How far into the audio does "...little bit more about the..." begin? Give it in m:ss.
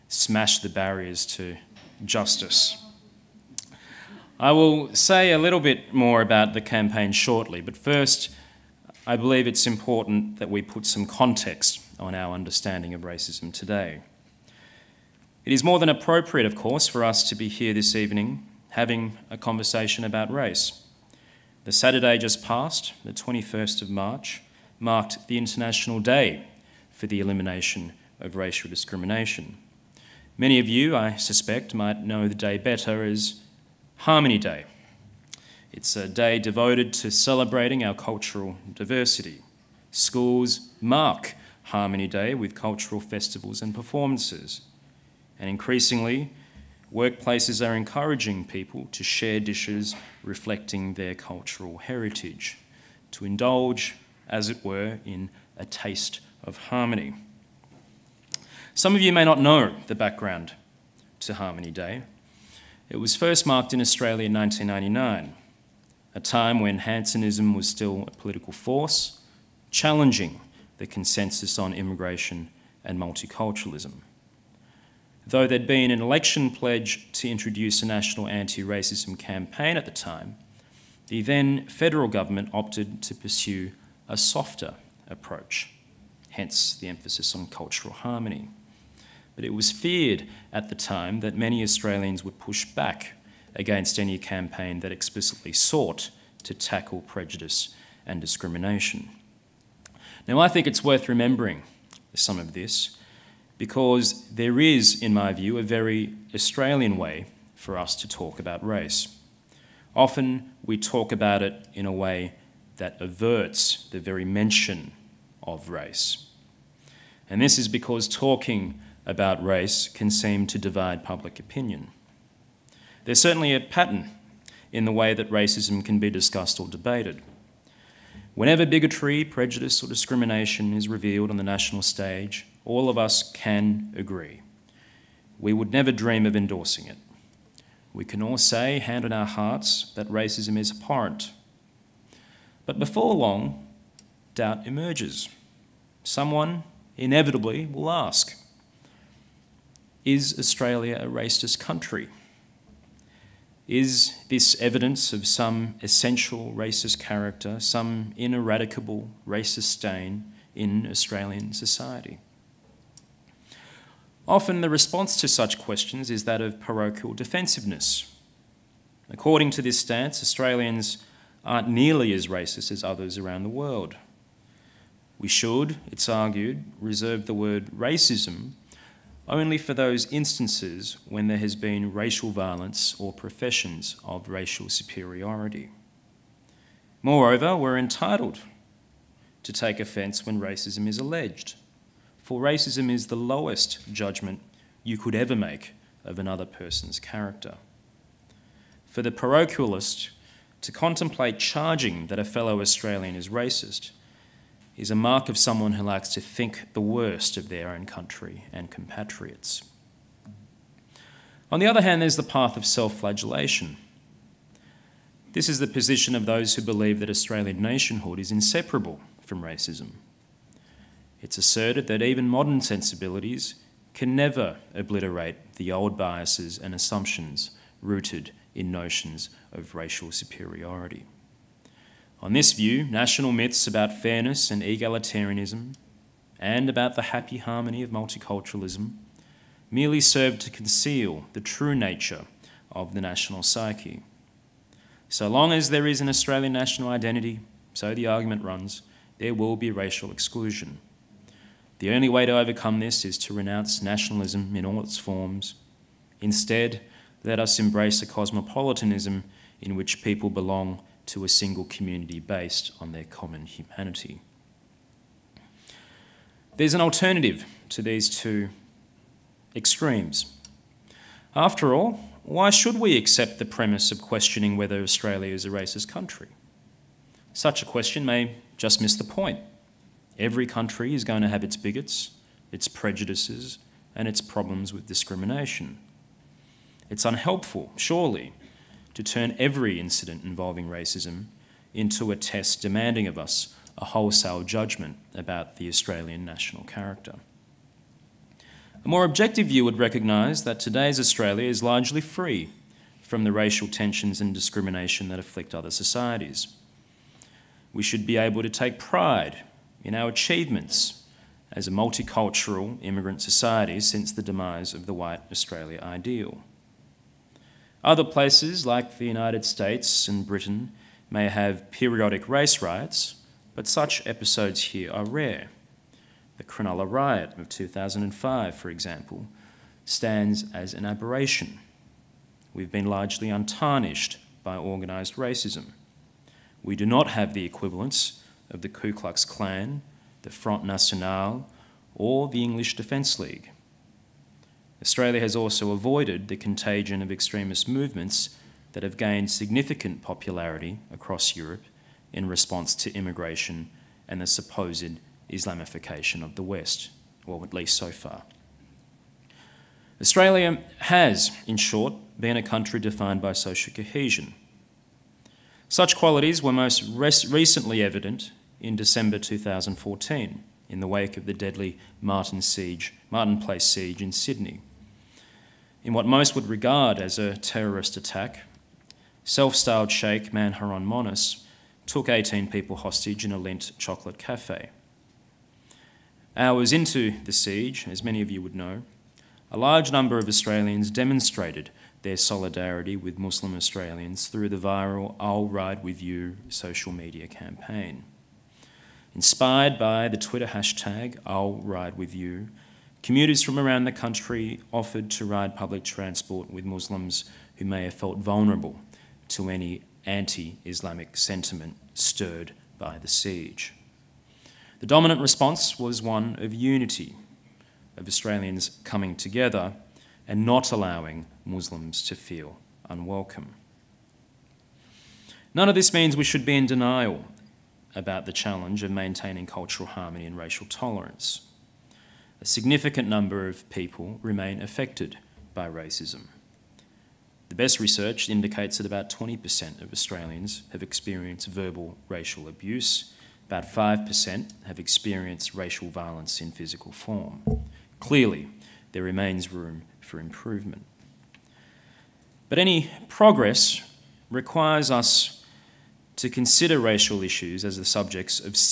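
0:05.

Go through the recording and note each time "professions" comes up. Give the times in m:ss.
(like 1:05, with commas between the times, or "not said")
3:03.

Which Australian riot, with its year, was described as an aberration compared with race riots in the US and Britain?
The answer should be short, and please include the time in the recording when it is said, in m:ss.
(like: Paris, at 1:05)
Cronulla riot of 2005, at 5:26.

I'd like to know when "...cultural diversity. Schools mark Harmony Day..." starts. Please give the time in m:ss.
0:37.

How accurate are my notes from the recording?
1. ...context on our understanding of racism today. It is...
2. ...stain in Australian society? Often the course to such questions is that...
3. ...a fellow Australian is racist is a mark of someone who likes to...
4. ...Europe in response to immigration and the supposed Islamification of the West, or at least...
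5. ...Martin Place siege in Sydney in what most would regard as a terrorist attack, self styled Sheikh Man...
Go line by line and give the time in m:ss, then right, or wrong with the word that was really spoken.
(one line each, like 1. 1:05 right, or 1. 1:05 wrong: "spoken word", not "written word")
1. 0:11 right
2. 2:39 wrong: "response", not "course"
3. 3:22 right
4. 5:51 right
5. 6:13 right.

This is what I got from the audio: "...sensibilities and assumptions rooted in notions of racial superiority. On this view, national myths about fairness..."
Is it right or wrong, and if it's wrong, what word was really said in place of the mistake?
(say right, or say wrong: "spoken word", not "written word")
wrong: "biases", not "sensibilities".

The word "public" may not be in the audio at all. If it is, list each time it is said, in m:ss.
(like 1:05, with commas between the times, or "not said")
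2:01, 6:45.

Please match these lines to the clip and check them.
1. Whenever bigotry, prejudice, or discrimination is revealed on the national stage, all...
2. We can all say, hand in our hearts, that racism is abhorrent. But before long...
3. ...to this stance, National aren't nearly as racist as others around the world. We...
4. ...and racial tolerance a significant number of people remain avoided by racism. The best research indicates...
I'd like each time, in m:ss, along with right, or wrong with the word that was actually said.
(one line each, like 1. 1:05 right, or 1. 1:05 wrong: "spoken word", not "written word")
1. 2:08 right
2. 2:17 right
3. 2:49 wrong: "Australians", not "National"
4. 7:10 wrong: "affected", not "avoided".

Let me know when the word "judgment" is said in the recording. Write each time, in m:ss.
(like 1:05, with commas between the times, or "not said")
3:13, 4:54.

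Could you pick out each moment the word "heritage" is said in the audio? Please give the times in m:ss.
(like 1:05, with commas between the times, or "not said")
0:51.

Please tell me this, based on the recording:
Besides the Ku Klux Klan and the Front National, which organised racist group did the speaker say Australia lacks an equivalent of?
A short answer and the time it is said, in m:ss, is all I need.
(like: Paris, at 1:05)
English Defence League, at 5:42.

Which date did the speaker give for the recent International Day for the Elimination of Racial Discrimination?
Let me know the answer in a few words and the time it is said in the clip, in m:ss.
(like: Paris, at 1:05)
21st of March, at 0:23.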